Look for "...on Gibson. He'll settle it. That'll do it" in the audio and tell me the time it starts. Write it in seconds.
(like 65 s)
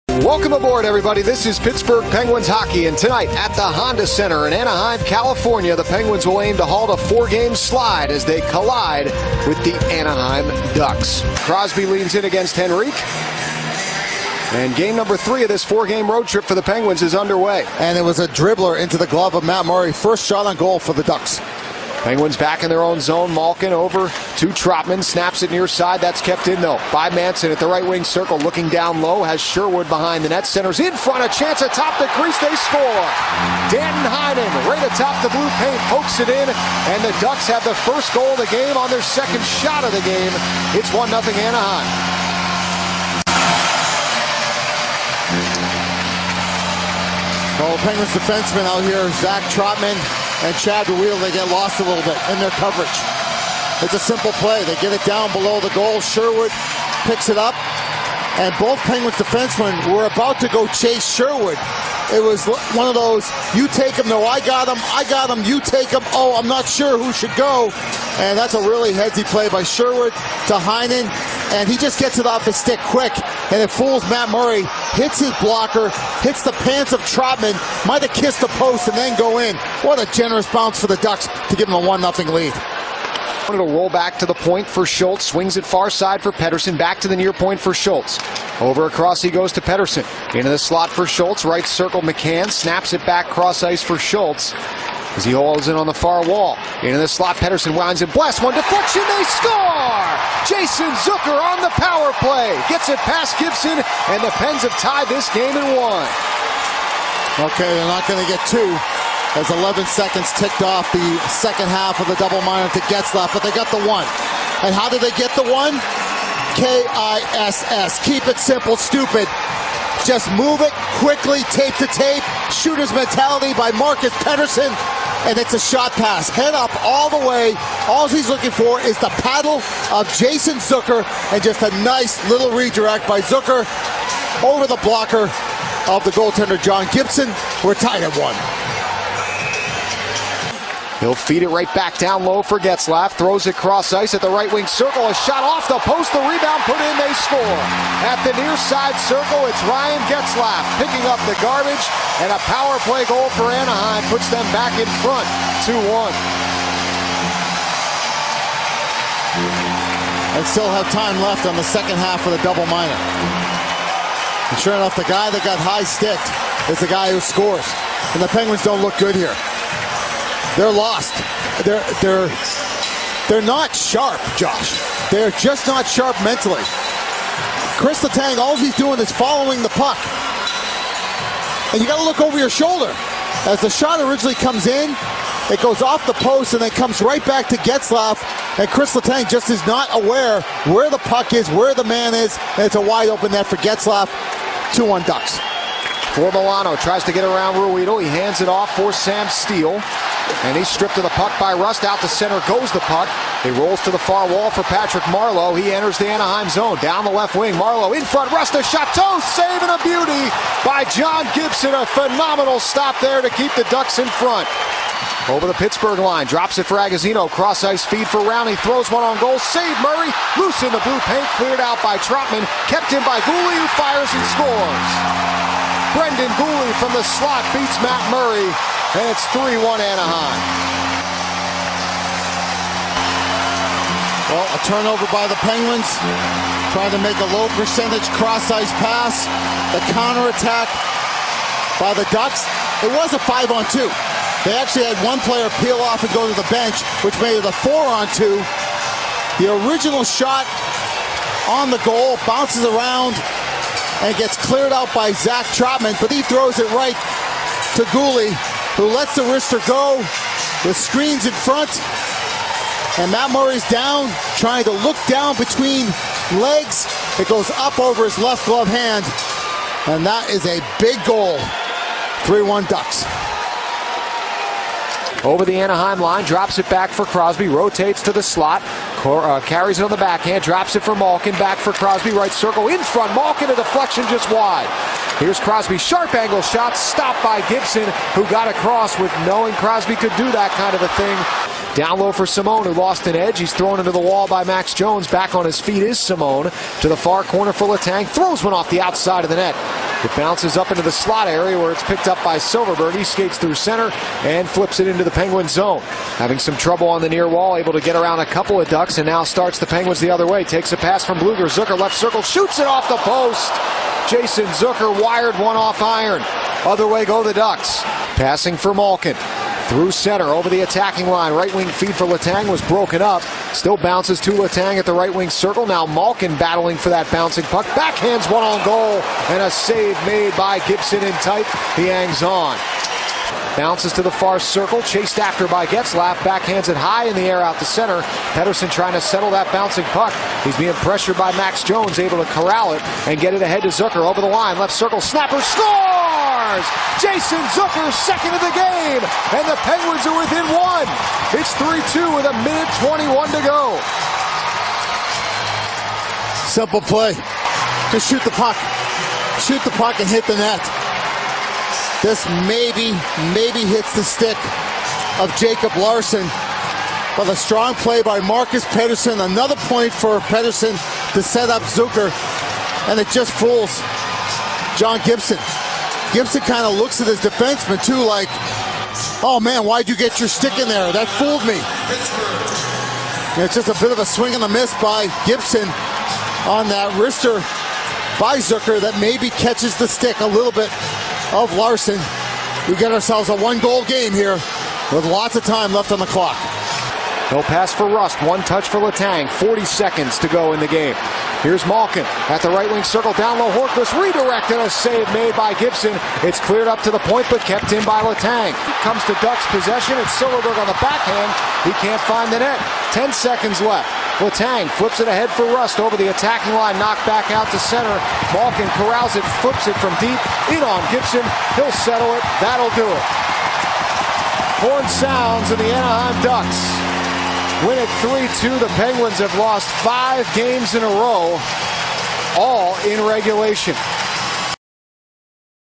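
420 s.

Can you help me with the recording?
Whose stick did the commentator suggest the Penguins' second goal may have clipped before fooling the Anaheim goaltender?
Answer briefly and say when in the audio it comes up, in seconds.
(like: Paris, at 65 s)
Jacob Larsson, at 365 s.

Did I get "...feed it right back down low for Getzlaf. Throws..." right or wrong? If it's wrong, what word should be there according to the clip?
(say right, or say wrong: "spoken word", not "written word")
right.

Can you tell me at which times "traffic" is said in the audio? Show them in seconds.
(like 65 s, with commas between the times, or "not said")
not said.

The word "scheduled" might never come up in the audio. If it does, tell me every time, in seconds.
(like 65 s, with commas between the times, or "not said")
not said.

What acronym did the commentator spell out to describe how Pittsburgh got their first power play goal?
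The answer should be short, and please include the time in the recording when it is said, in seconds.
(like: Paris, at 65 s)
K-I-S-S, at 116 s.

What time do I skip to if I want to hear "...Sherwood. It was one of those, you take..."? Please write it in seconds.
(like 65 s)
61 s.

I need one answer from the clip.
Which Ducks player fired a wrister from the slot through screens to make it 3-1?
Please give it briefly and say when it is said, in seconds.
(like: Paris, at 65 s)
Brendan Guhle, at 225 s.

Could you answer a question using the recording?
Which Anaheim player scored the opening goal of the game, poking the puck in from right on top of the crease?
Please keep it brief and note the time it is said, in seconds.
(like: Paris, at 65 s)
Danton Heinen, at 33 s.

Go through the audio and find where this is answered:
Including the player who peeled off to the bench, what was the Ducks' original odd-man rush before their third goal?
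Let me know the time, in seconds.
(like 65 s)
243 s.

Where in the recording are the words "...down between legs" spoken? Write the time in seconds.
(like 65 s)
265 s.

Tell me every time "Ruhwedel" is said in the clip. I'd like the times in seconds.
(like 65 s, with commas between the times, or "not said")
50 s, 197 s.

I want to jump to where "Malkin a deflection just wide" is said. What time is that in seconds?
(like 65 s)
283 s.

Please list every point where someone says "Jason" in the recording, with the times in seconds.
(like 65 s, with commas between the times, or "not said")
100 s, 130 s, 314 s, 346 s.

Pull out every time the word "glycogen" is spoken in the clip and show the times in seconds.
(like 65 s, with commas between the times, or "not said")
not said.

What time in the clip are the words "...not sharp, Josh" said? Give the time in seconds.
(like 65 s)
173 s.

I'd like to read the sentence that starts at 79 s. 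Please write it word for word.
What a generous bounce for the Ducks to give them a 1-0 lead.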